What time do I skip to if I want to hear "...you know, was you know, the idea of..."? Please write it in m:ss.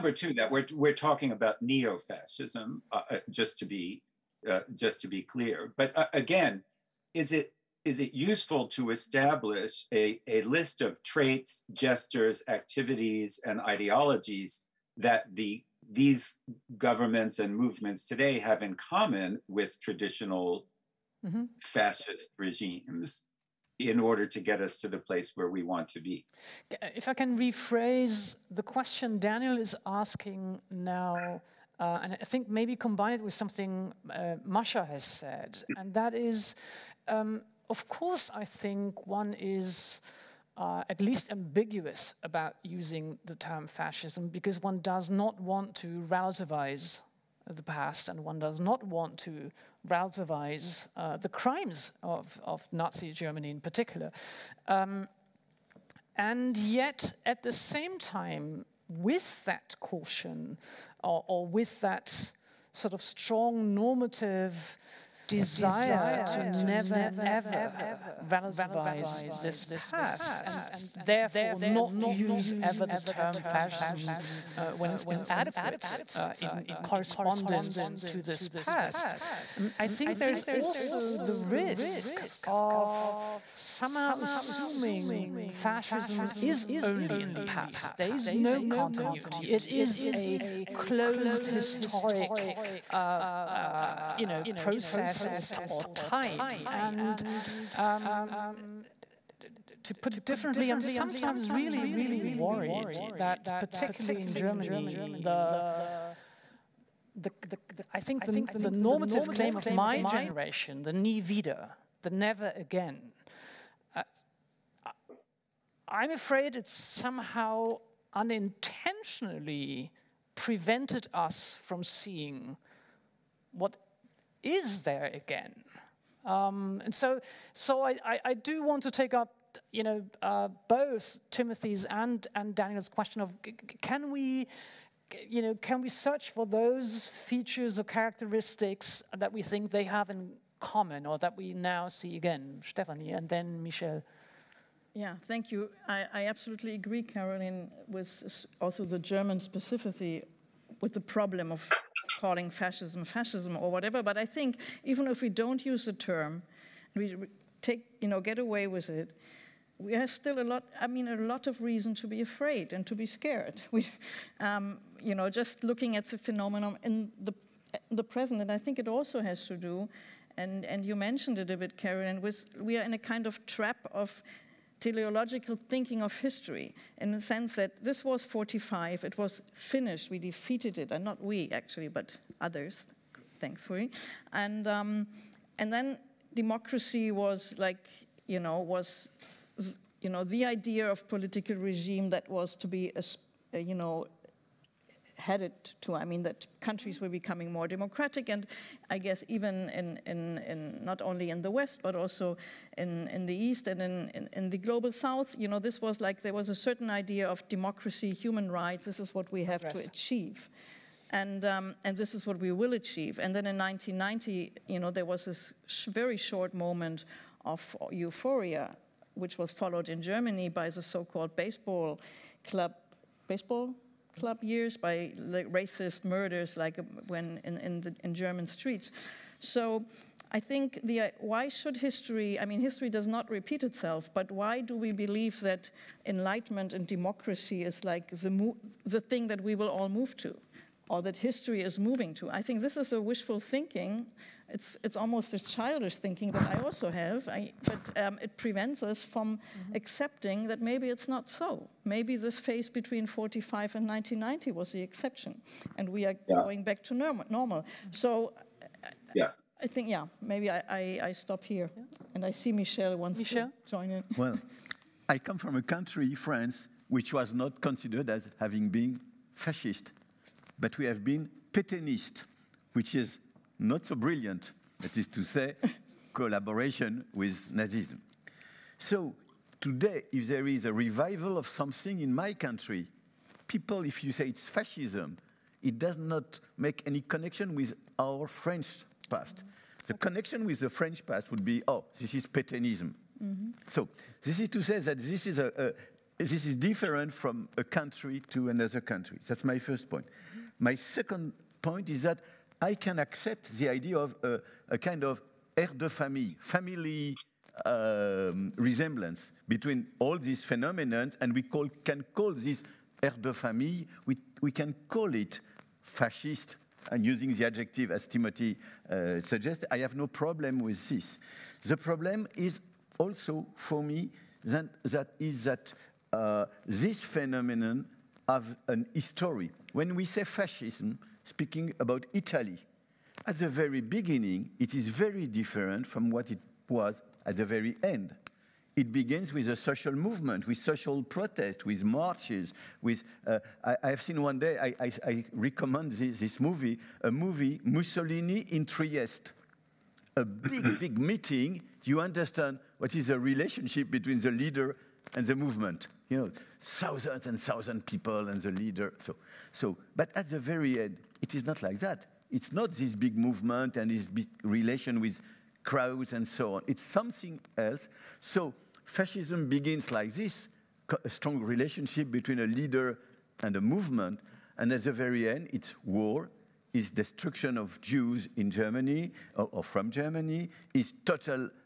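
3:08.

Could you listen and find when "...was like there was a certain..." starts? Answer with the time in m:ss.
3:25.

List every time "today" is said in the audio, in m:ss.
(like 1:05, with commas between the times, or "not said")
0:18, 4:39.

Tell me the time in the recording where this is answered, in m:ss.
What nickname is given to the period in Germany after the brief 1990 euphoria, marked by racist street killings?
3:41.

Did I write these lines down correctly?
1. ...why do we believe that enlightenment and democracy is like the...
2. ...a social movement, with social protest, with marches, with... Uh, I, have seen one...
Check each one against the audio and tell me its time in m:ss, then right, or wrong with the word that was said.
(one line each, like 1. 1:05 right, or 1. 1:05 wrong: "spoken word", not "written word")
1. 3:54 right
2. 5:39 right.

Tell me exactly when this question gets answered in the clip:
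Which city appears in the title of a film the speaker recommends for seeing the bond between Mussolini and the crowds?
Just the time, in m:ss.
5:48.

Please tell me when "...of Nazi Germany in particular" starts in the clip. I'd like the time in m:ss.
0:52.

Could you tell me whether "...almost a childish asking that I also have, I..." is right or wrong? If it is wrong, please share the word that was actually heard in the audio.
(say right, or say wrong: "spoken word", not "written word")
wrong: "thinking", not "asking".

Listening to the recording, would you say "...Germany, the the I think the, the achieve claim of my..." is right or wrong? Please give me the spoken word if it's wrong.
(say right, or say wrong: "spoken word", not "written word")
wrong: "normative", not "achieve".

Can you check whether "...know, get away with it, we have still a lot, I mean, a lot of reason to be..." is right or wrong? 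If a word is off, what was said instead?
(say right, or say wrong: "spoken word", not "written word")
right.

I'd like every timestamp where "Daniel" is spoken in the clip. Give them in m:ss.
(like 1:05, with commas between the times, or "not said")
0:29, 2:12.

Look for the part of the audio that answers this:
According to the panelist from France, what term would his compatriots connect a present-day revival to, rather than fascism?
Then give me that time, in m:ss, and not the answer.
4:52.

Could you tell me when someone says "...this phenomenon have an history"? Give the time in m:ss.
5:26.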